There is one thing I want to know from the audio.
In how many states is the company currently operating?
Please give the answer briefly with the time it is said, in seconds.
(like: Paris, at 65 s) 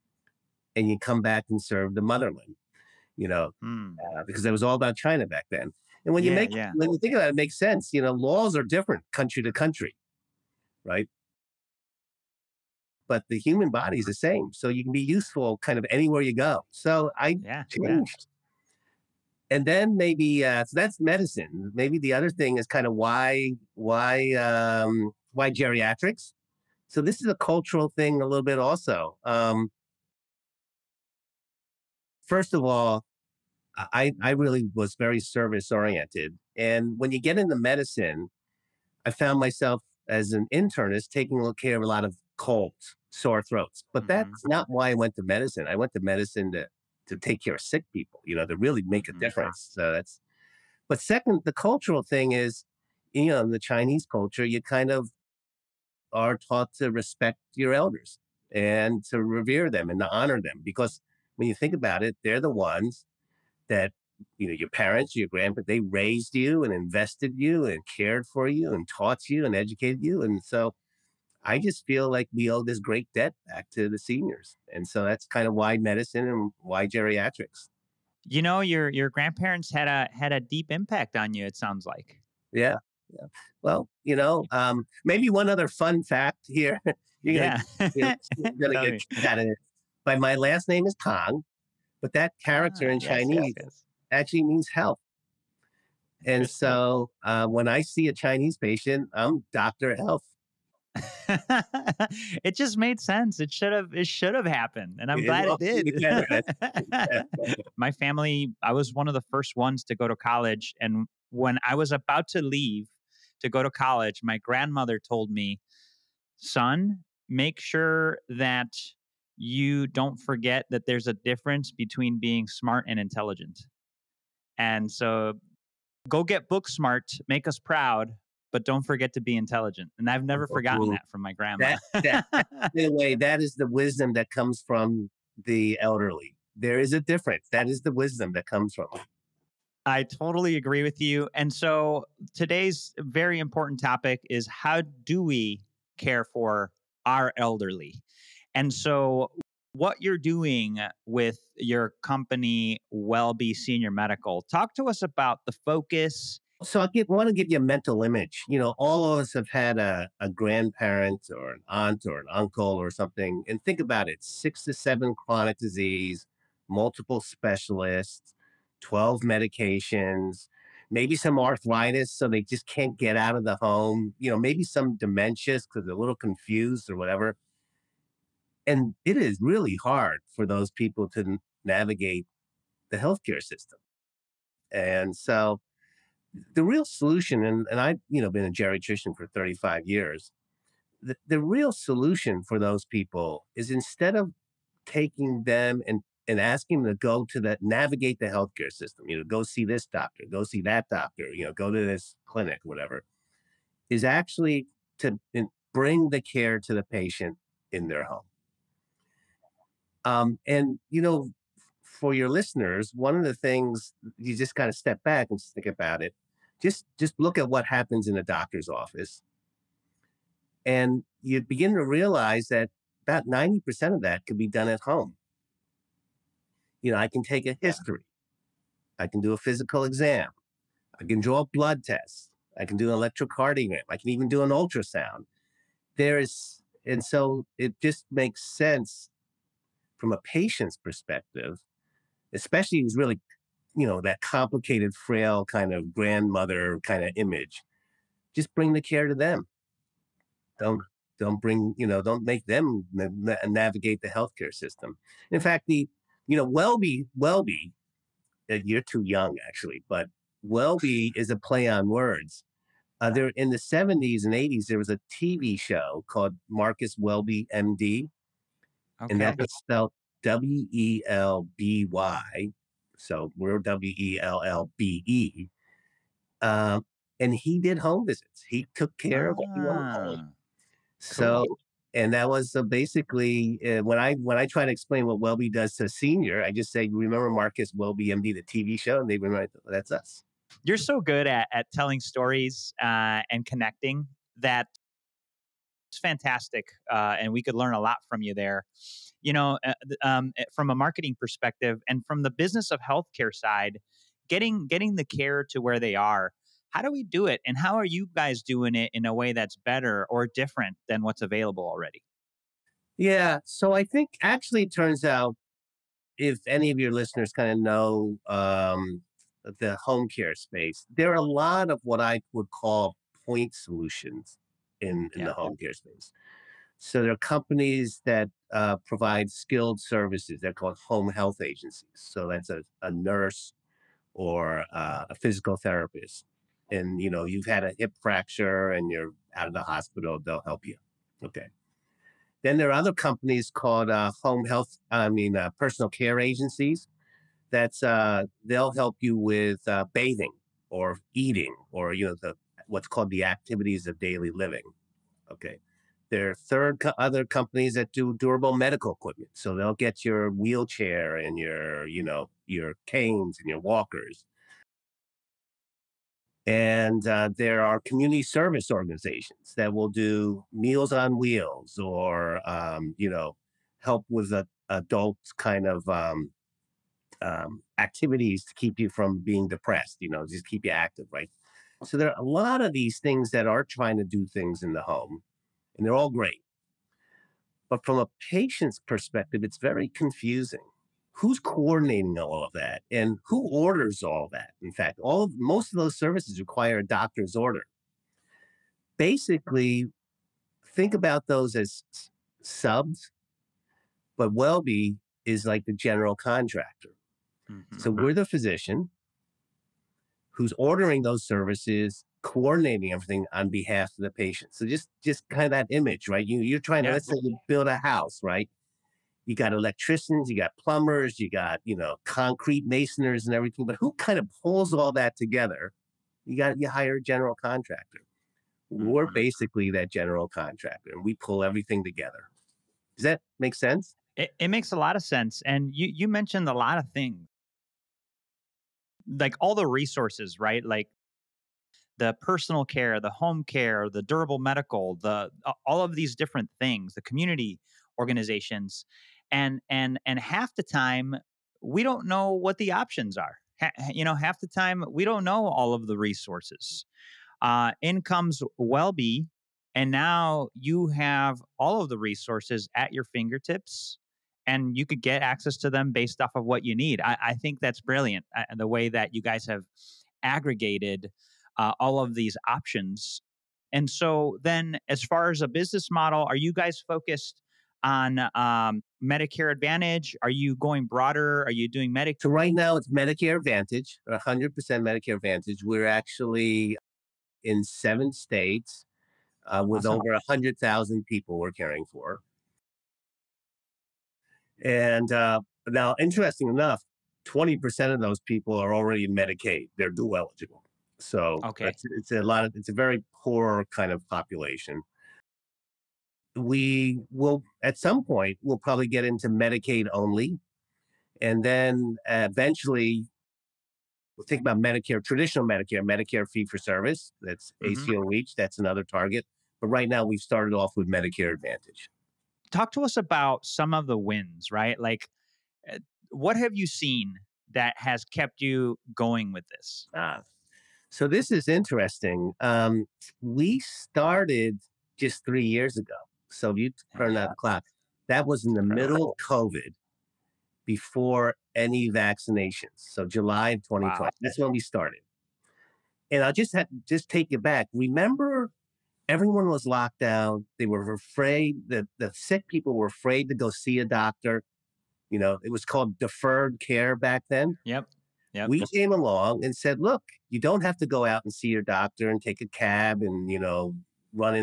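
7, at 487 s.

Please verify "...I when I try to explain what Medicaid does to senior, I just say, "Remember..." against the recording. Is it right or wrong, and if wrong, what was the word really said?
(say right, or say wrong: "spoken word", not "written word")
wrong: "WellBe", not "Medicaid".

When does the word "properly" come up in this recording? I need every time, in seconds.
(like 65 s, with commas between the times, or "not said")
not said.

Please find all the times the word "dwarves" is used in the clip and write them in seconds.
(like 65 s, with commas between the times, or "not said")
not said.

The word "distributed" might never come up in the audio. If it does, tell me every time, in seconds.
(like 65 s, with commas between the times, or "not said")
not said.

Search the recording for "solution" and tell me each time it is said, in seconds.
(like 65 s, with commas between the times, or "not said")
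186 s, 191 s, 323 s.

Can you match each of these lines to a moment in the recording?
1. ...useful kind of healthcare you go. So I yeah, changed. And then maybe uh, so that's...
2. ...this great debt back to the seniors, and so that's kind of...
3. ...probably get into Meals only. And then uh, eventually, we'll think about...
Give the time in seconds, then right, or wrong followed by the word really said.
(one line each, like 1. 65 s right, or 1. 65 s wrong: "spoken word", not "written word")
1. 15 s wrong: "anywhere", not "healthcare"
2. 72 s right
3. 508 s wrong: "Medicaid", not "Meals".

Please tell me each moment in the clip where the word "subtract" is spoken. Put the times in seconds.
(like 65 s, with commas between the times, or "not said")
not said.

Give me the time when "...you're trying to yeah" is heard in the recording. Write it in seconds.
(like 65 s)
416 s.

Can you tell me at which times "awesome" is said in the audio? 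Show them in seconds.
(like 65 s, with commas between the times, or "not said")
489 s.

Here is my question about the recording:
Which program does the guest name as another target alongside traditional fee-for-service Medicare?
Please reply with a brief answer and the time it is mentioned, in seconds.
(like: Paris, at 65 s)
ACO REACH, at 517 s.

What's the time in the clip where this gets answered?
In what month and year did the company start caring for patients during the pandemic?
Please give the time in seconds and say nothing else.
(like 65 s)
543 s.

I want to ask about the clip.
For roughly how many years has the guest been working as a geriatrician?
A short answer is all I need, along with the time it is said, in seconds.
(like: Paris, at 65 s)
35 years, at 189 s.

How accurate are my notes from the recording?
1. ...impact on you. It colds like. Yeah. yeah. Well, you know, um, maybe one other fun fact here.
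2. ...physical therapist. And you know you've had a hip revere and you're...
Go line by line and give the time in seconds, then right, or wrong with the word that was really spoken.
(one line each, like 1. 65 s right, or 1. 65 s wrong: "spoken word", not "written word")
1. 80 s wrong: "sounds", not "colds"
2. 335 s wrong: "fracture", not "revere".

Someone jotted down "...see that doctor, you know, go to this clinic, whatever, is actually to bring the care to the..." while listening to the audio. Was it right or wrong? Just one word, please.
right.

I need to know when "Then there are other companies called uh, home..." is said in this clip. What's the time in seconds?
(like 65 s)
342 s.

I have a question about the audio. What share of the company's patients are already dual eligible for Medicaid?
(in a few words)
20%.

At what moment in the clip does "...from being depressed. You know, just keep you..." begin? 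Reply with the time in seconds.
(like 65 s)
378 s.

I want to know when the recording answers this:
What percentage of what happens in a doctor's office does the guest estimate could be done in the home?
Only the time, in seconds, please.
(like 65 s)
223 s.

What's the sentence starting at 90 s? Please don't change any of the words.
But my last name is Kang, but that character ah, in yes, Chinese yes.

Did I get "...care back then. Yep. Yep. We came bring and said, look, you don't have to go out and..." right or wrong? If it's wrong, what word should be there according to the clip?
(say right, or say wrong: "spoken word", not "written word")
wrong: "along", not "bring".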